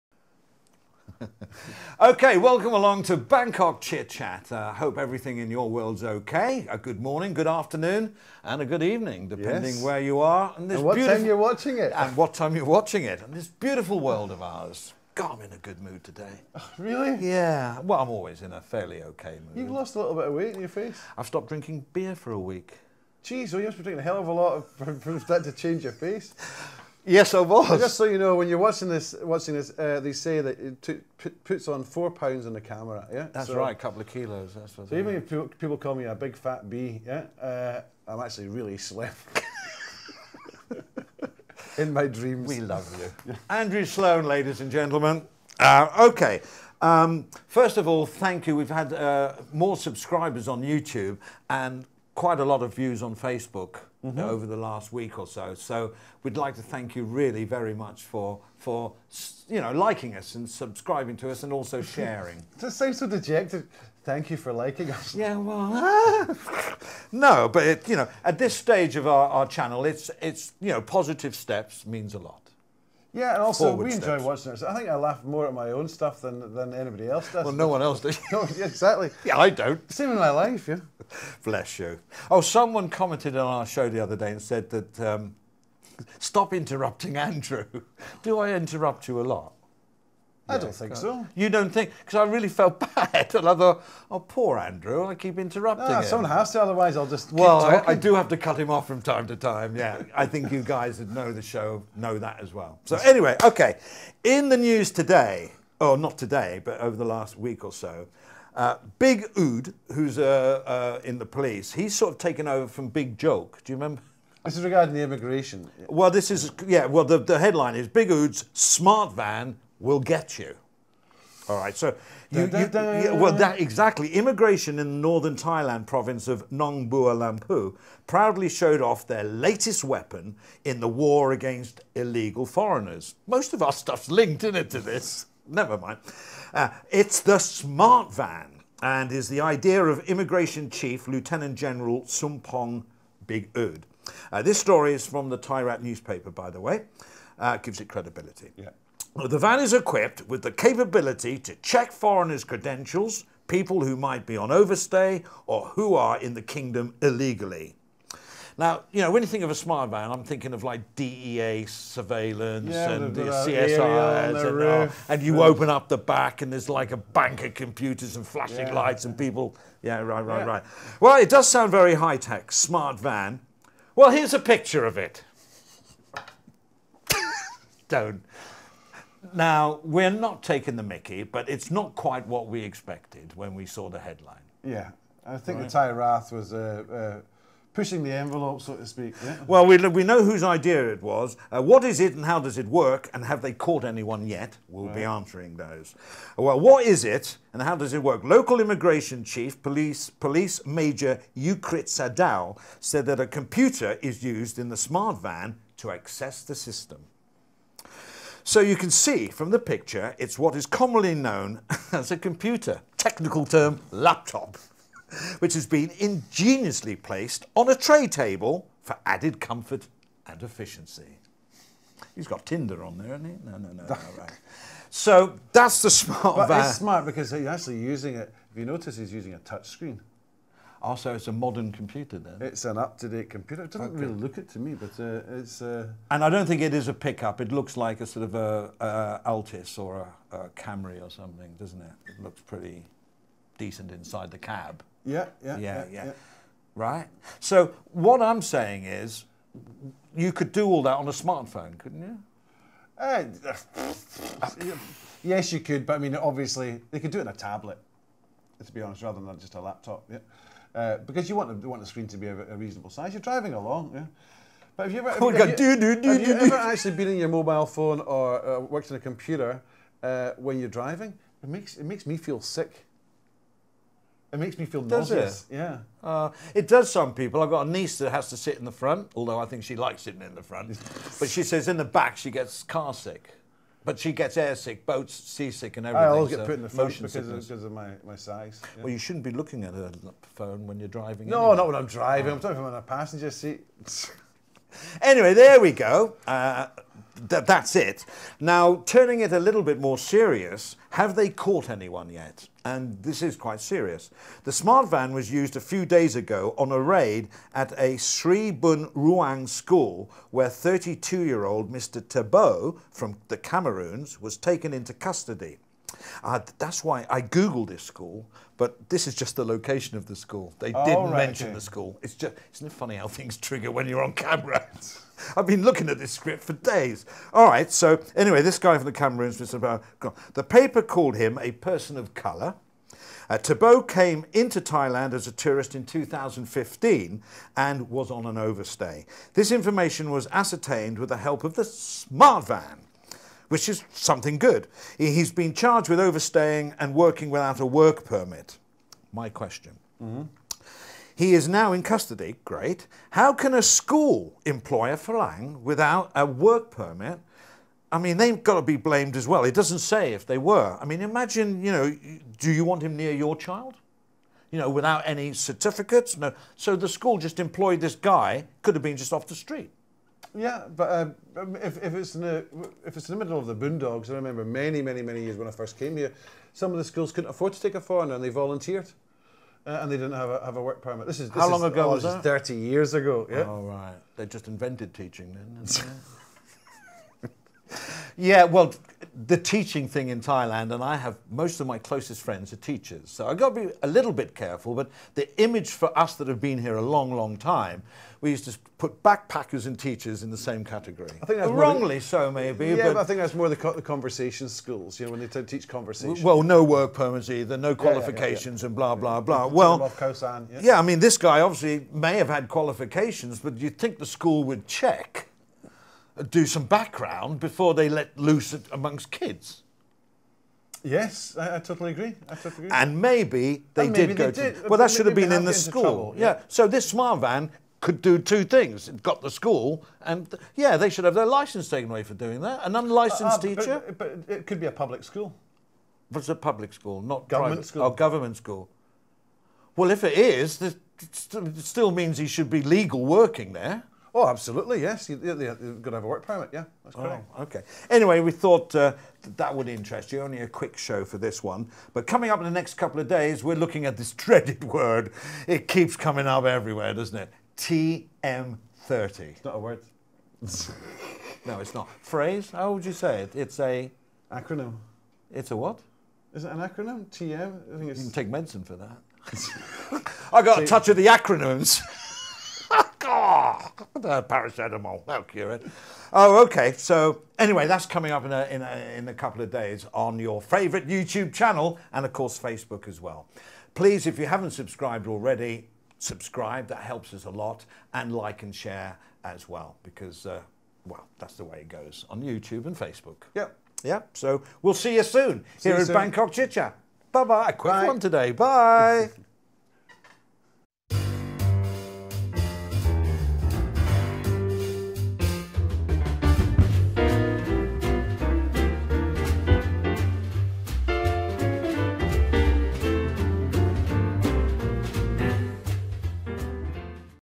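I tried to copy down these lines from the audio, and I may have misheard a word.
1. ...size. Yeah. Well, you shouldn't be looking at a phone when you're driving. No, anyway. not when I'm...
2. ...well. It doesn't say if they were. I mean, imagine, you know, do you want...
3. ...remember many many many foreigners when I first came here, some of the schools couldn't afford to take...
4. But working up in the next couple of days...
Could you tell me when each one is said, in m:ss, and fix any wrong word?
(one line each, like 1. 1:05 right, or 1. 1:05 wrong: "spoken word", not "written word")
1. 4:48 right
2. 5:59 right
3. 6:14 wrong: "years", not "foreigners"
4. 7:31 wrong: "coming", not "working".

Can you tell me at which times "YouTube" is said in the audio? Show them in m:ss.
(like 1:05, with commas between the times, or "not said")
0:50, 8:00, 8:12.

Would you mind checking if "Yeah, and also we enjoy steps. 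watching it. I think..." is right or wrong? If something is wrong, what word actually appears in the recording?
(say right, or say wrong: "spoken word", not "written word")
right.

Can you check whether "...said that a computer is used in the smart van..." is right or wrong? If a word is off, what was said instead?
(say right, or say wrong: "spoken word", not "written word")
right.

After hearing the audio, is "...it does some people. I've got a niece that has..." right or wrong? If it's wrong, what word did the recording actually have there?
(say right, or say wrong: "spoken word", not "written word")
right.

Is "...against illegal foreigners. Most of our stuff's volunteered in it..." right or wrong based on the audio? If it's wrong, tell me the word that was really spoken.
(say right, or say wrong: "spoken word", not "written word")
wrong: "linked", not "volunteered".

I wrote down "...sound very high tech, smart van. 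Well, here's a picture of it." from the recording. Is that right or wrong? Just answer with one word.
right.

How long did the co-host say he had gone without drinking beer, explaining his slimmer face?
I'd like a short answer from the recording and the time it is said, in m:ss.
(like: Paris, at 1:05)
a week, at 0:22.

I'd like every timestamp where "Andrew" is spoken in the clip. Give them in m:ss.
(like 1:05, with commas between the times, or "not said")
0:43, 1:27, 1:34.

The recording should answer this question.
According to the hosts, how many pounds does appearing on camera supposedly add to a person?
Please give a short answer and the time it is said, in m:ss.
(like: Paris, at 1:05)
4, at 0:31.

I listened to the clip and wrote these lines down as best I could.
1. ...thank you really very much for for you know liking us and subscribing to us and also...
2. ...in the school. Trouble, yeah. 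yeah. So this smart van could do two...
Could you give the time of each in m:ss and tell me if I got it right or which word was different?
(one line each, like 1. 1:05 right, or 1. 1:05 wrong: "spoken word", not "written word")
1. 0:56 right
2. 7:05 right.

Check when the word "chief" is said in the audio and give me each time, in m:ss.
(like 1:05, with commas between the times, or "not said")
2:20, 3:19.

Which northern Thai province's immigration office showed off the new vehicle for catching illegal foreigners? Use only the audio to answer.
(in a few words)
Nong Bua Lamphu.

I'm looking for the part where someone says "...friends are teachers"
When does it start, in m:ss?
6:32.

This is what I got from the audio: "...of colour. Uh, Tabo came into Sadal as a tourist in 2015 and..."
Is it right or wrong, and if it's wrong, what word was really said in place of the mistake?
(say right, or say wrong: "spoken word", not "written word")
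wrong: "Thailand", not "Sadal".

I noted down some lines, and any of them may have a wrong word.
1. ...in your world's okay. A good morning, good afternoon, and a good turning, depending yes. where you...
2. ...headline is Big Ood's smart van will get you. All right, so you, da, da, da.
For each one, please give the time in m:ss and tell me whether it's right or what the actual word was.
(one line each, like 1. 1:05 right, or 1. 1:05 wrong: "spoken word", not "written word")
1. 0:05 wrong: "evening", not "turning"
2. 1:57 right.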